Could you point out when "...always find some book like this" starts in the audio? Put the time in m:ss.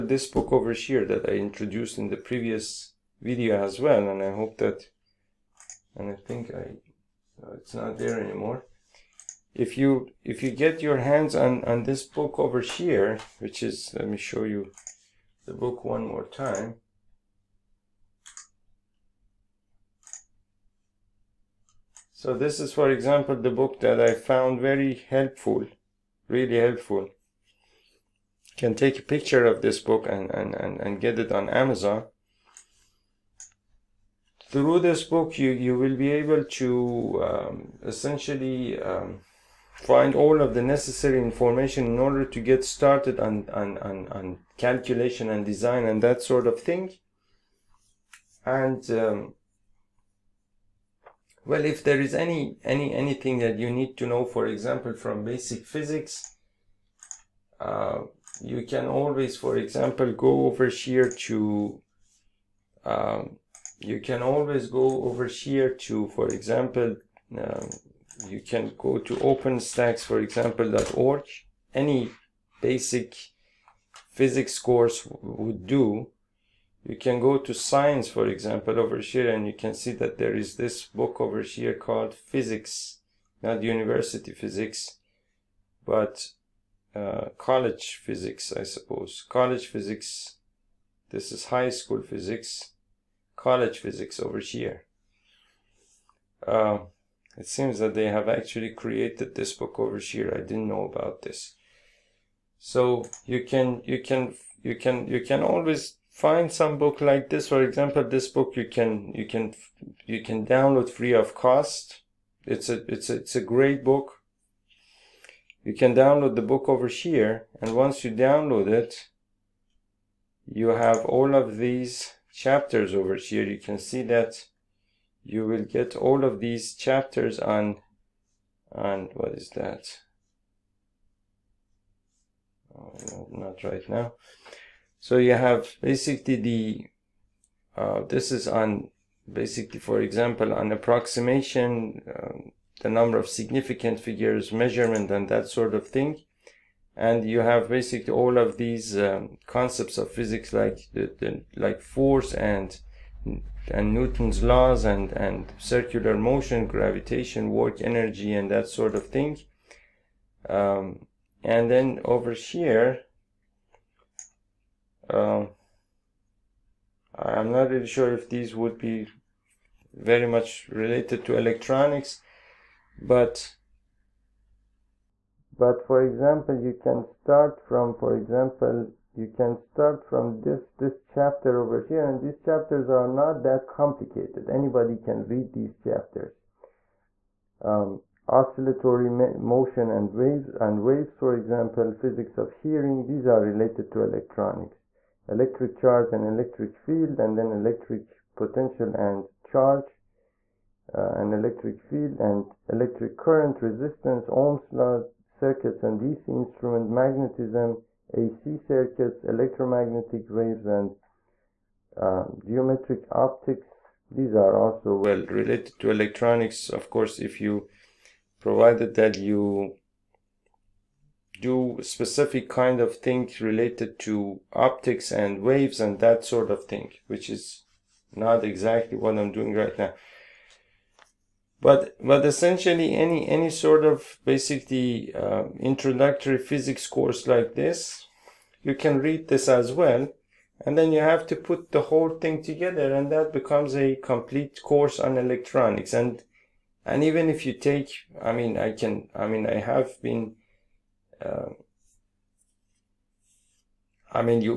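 1:45.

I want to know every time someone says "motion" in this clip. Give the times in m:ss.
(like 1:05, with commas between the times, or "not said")
2:36, 3:09.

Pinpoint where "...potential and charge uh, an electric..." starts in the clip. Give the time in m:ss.
3:18.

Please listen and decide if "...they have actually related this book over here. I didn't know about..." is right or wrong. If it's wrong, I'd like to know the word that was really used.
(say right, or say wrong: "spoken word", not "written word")
wrong: "created", not "related".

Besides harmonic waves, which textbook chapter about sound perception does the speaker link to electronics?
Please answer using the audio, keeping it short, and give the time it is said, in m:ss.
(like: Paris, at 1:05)
Physics of hearing, at 3:11.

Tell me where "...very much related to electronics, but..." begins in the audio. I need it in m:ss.
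2:49.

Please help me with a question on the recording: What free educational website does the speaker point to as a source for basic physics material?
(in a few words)
OpenStax.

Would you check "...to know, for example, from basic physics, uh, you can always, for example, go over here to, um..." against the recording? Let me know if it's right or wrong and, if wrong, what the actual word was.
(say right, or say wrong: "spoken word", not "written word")
right.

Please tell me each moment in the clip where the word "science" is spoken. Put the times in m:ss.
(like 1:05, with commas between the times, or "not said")
1:17.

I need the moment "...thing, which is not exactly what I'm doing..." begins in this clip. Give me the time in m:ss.
3:46.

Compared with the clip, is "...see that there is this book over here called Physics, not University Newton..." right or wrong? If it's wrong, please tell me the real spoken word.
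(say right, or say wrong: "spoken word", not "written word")
wrong: "Physics", not "Newton".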